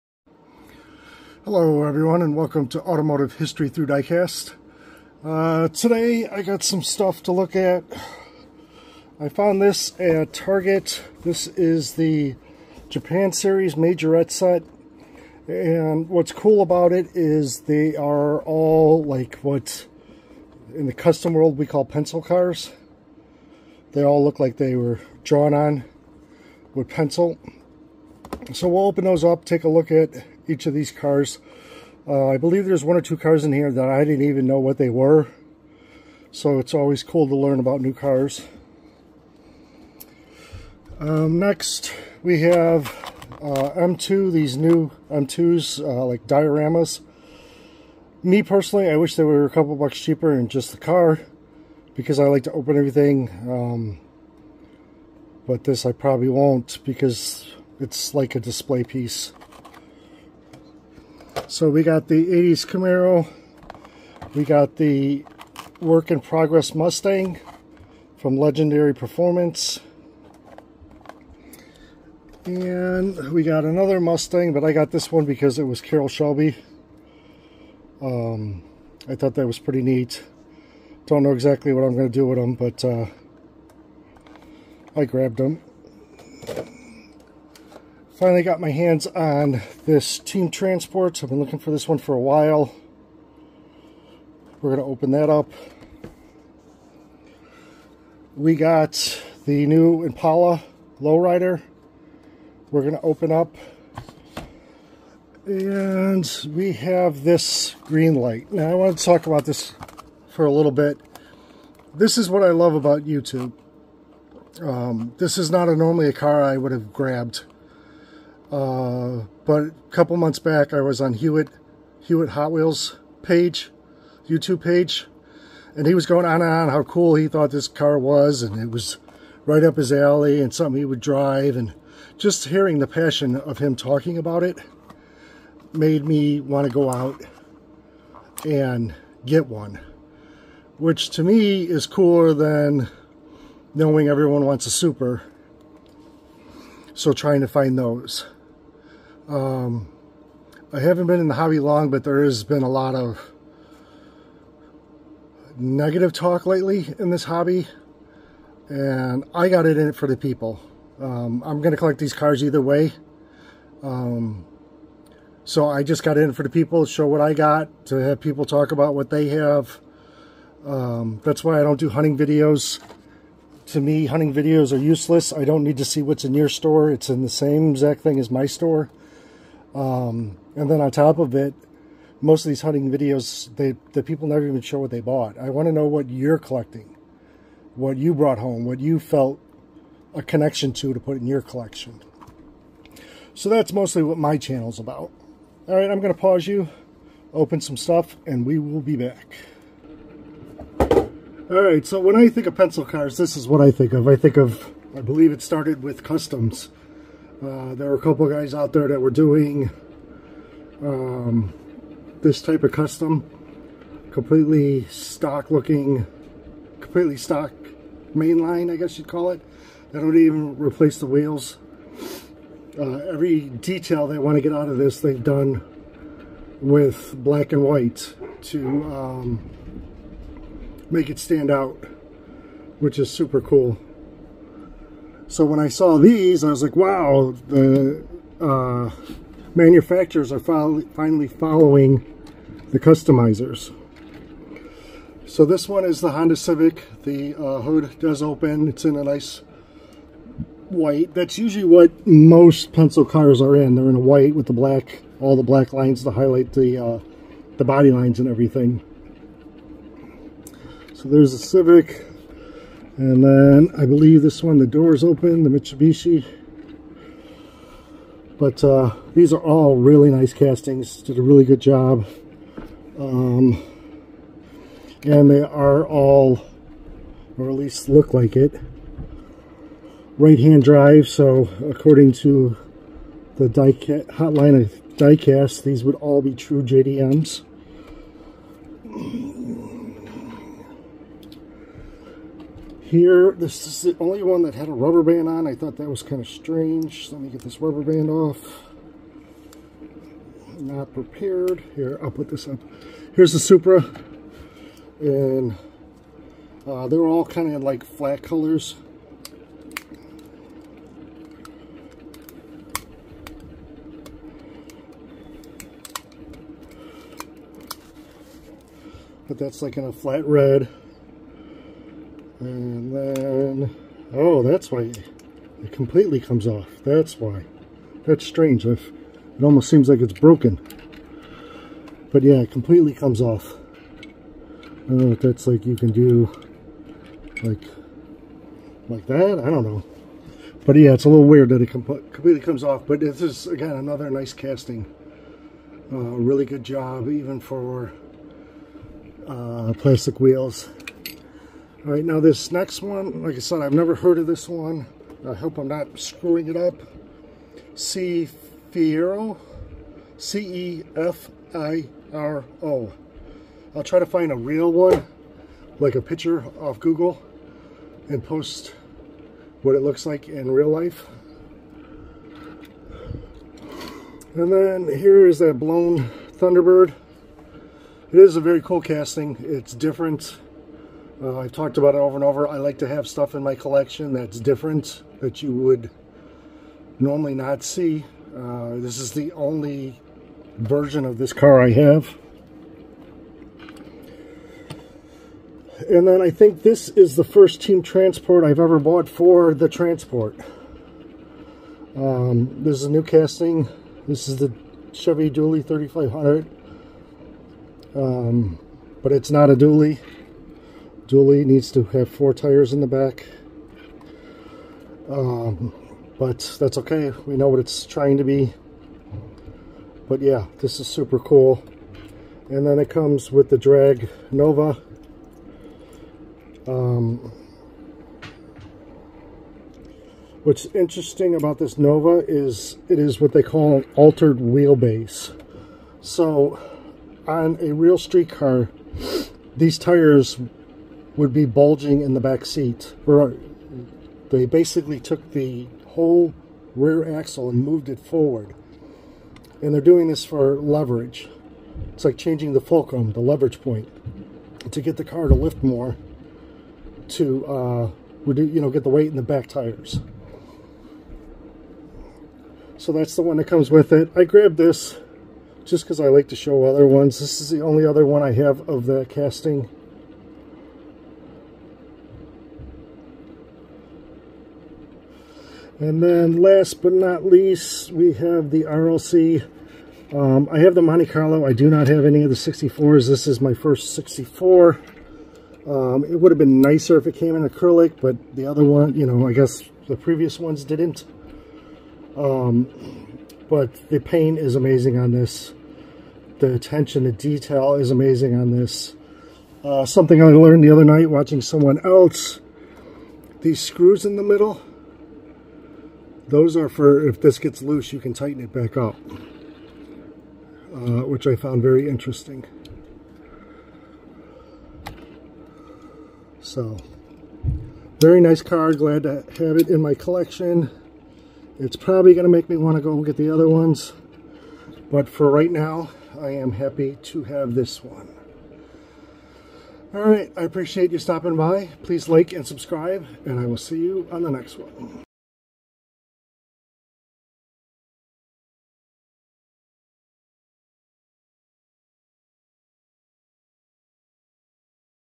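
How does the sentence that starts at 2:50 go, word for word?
Um, that's why I don't do hunting videos.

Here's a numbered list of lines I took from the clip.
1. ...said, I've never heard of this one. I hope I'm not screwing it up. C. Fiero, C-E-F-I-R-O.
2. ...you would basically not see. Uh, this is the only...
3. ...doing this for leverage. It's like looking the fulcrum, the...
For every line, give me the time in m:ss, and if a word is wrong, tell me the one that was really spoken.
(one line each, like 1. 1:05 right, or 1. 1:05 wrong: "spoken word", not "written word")
1. 5:53 right
2. 6:25 wrong: "normally", not "basically"
3. 7:29 wrong: "changing", not "looking".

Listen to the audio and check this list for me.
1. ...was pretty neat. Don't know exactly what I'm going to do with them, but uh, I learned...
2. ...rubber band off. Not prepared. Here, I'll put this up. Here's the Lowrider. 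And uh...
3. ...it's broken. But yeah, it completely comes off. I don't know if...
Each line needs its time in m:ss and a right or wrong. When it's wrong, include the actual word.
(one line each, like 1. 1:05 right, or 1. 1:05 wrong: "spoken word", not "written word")
1. 1:19 wrong: "grabbed", not "learned"
2. 4:57 wrong: "Supra", not "Lowrider"
3. 5:30 right.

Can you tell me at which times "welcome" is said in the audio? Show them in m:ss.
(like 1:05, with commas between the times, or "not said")
0:02.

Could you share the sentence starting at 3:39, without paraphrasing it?
They don't even replace the wheels.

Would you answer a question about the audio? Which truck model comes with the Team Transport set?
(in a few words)
Chevy Dually 3500.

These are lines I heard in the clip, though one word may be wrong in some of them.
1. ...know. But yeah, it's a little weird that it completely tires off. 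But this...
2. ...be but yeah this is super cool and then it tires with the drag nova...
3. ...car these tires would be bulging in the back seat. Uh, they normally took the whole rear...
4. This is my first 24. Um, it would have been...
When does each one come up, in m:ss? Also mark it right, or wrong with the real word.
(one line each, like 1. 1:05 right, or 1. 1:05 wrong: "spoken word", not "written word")
1. 5:39 wrong: "comes", not "tires"
2. 6:58 wrong: "comes", not "tires"
3. 7:18 wrong: "basically", not "normally"
4. 8:03 wrong: "64", not "24".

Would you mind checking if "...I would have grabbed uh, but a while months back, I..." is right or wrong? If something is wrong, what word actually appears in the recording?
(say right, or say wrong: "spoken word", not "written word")
wrong: "couple", not "while".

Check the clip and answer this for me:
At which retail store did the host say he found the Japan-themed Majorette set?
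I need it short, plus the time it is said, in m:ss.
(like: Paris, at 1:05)
Target, at 0:10.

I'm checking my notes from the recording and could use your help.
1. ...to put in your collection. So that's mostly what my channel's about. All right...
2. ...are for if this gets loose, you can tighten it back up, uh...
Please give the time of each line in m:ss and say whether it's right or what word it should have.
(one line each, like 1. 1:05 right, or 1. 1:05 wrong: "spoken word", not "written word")
1. 3:10 right
2. 8:26 right.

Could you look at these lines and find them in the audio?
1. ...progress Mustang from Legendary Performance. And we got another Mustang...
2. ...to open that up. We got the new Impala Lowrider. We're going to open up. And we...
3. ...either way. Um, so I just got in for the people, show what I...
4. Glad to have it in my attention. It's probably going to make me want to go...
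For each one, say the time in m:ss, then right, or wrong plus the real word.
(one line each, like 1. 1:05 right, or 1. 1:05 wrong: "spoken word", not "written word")
1. 1:06 right
2. 1:34 right
3. 2:42 right
4. 8:38 wrong: "collection", not "attention".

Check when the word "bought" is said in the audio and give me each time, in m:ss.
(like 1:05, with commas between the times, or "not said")
3:04, 6:38.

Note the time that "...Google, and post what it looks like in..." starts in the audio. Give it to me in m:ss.
6:06.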